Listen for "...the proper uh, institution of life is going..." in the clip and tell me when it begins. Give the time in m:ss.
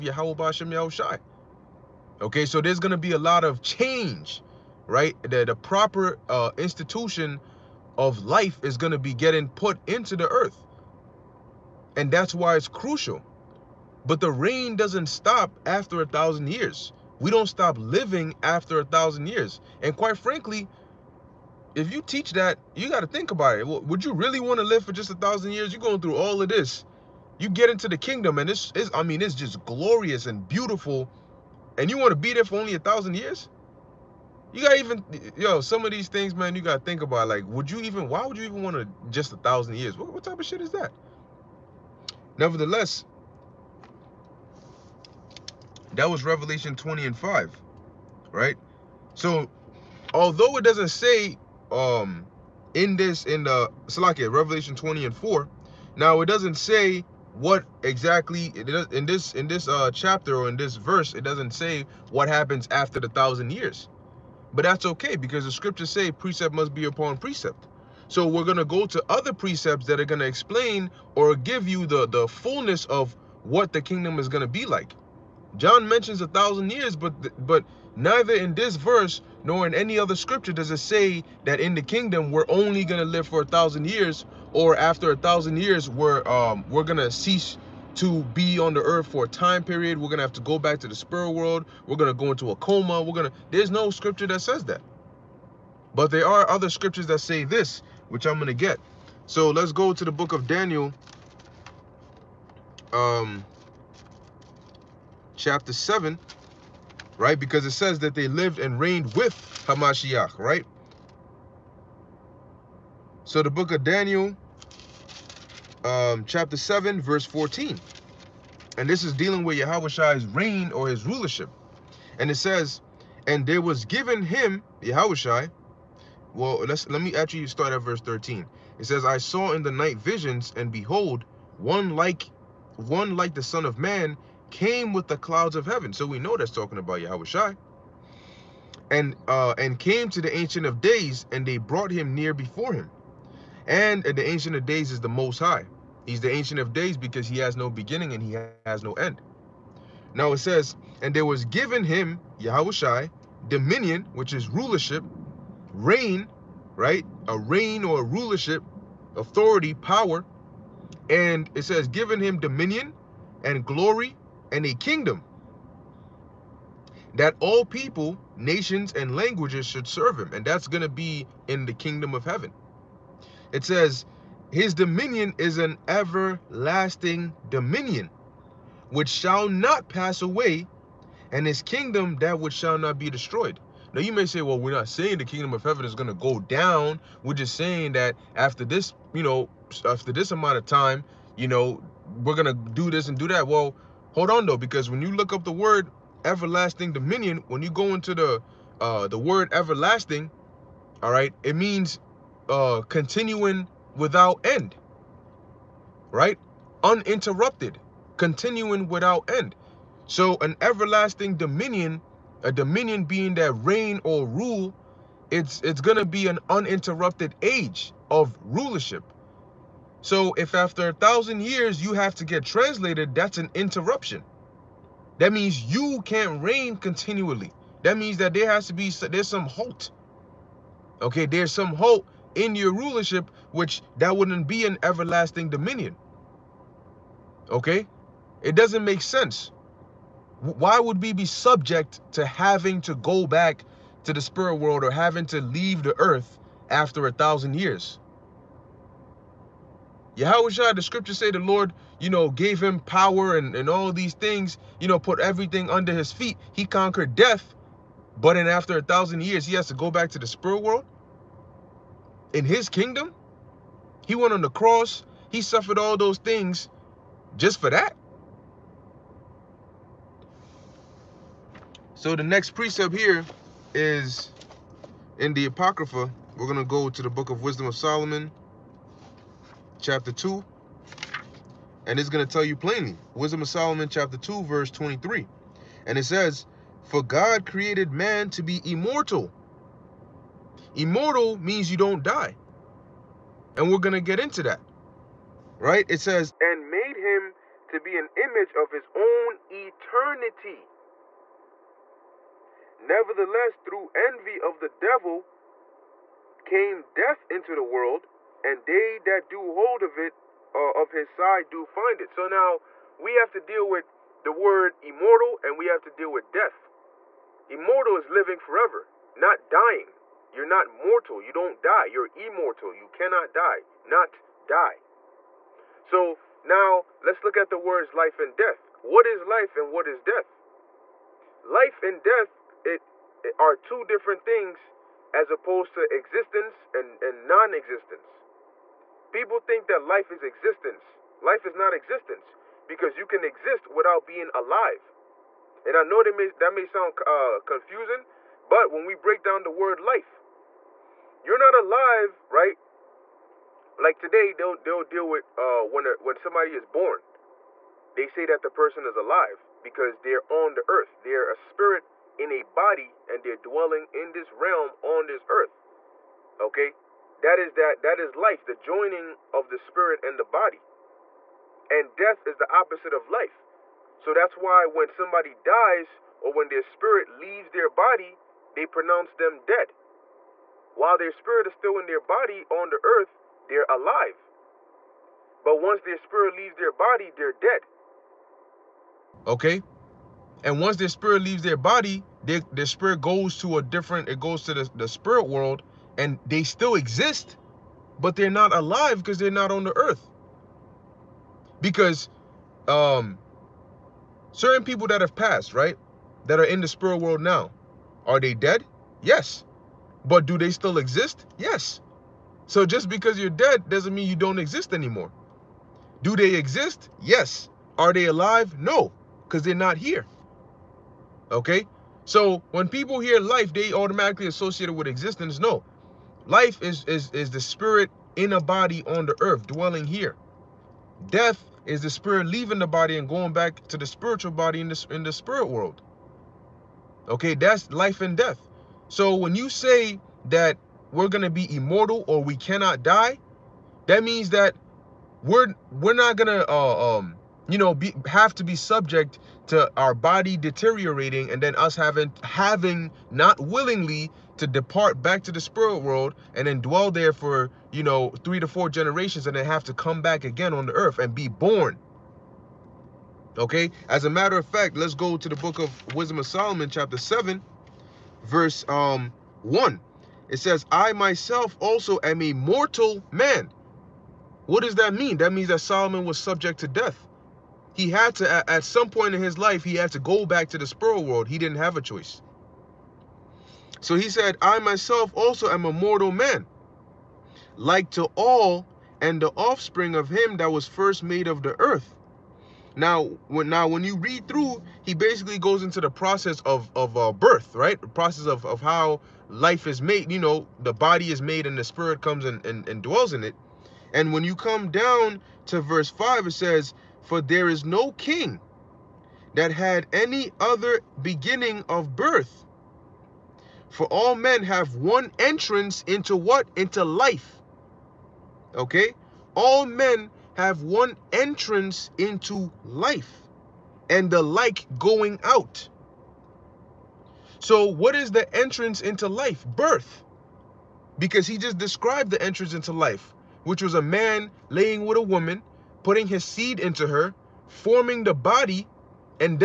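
0:05.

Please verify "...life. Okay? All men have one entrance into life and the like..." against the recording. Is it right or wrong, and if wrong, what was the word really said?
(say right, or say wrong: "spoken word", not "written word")
right.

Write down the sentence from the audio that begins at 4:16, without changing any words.
He conquered death, but then after a thousand years, he has to go back to the spirit world in his kingdom?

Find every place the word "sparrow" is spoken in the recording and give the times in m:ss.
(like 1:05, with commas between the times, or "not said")
8:00.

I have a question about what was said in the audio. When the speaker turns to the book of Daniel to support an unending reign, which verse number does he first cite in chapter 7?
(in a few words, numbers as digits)
14.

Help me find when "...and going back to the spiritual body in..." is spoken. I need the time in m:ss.
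7:12.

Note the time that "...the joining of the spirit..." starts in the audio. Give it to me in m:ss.
6:08.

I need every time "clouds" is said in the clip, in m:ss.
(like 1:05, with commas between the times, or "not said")
2:15.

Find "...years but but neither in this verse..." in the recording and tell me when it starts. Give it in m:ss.
1:16.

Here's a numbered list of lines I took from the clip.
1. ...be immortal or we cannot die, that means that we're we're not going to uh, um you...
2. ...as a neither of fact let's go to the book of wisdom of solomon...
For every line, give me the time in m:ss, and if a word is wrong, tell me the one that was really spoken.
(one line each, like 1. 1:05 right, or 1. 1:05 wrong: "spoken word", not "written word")
1. 7:21 right
2. 7:43 wrong: "matter", not "neither".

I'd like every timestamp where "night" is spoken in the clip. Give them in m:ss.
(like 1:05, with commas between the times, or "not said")
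2:09.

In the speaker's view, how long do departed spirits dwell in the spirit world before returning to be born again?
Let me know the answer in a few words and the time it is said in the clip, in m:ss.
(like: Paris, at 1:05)
Three to four generations, at 7:38.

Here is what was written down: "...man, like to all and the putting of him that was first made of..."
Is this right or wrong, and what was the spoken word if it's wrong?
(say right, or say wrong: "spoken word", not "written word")
wrong: "offspring", not "putting".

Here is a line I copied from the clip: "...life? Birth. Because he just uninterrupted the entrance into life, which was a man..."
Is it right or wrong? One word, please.
wrong.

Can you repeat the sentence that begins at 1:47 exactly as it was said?
Because it says that they lived and reigned with Hamashiach, right?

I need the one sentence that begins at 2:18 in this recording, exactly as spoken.
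And uh and came to the ancient of days, and they brought him near before him.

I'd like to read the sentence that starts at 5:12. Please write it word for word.
So now we have to deal with the word immortal and we have to deal with death.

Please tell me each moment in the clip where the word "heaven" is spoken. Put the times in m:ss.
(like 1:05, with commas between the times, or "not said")
2:15, 2:52, 3:05.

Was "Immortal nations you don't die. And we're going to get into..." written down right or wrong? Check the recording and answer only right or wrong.
wrong.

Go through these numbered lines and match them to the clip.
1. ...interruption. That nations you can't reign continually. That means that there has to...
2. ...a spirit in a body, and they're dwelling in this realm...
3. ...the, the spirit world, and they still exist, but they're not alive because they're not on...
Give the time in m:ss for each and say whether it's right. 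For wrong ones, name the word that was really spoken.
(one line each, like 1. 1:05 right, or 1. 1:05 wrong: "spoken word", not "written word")
1. 3:43 wrong: "means", not "nations"
2. 6:01 right
3. 6:34 right.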